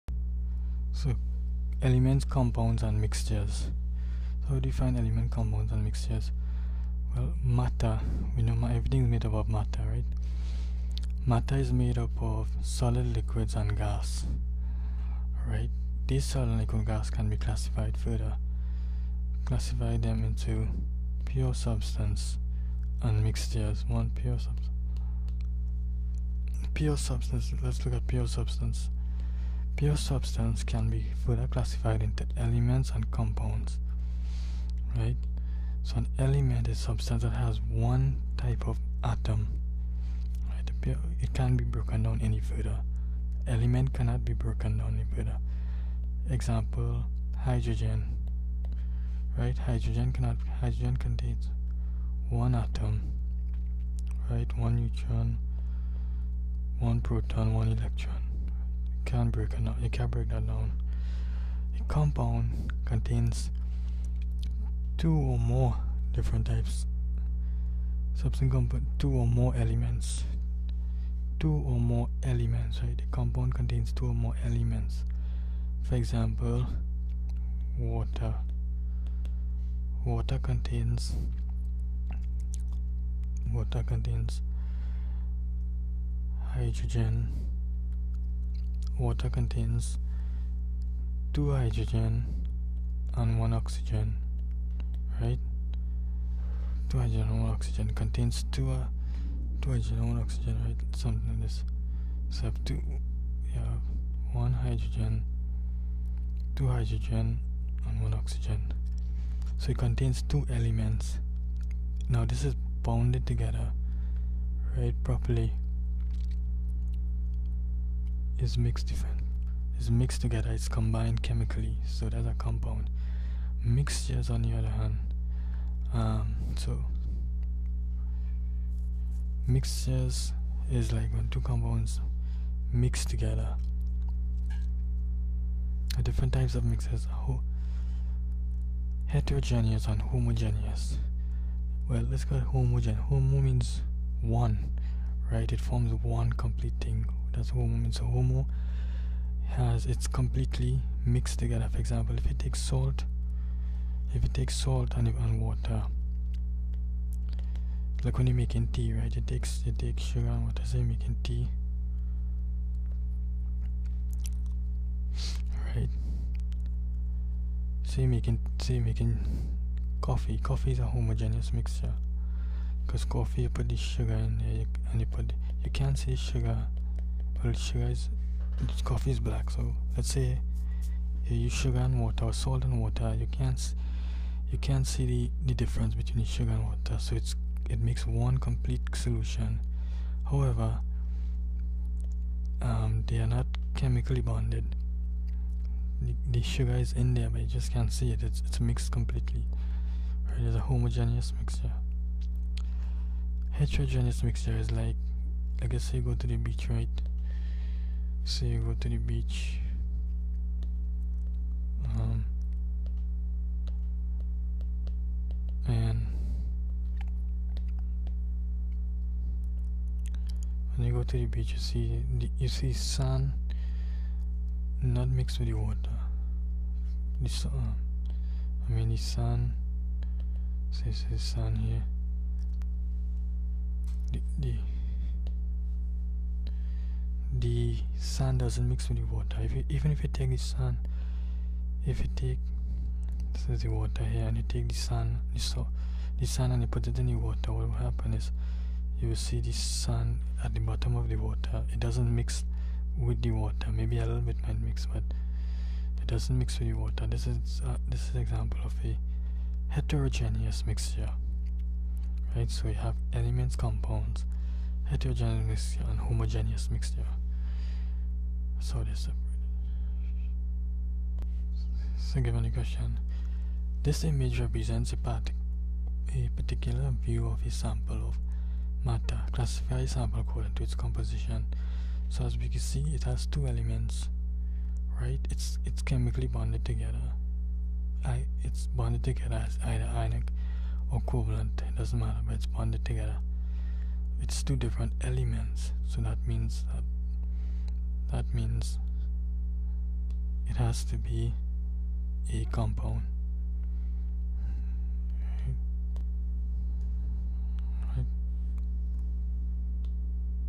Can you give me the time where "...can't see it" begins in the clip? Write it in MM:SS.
03:17.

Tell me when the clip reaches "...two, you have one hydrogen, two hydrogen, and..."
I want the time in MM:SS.
01:42.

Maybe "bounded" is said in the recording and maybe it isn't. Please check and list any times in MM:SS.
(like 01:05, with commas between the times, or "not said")
01:52.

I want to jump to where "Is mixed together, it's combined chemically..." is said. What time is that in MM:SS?
01:59.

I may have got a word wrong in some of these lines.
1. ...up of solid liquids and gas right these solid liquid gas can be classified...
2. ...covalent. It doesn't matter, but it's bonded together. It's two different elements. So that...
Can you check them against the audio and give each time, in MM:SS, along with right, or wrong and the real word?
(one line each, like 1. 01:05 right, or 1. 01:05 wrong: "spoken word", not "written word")
1. 00:11 right
2. 04:51 right.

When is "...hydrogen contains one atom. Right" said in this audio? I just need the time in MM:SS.
00:50.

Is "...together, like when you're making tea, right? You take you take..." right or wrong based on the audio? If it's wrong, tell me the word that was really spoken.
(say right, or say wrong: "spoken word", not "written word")
wrong: "water", not "together".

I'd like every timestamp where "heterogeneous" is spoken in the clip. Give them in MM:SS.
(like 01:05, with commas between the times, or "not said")
02:19, 03:23, 04:19, 04:24.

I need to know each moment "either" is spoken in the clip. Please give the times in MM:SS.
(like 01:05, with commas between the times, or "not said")
04:49.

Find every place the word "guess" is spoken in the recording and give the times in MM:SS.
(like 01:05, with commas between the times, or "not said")
03:25.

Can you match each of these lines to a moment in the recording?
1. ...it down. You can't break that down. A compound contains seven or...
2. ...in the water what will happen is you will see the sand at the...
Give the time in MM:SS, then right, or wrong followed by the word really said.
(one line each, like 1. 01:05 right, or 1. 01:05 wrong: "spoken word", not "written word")
1. 00:59 wrong: "two", not "seven"
2. 04:06 right.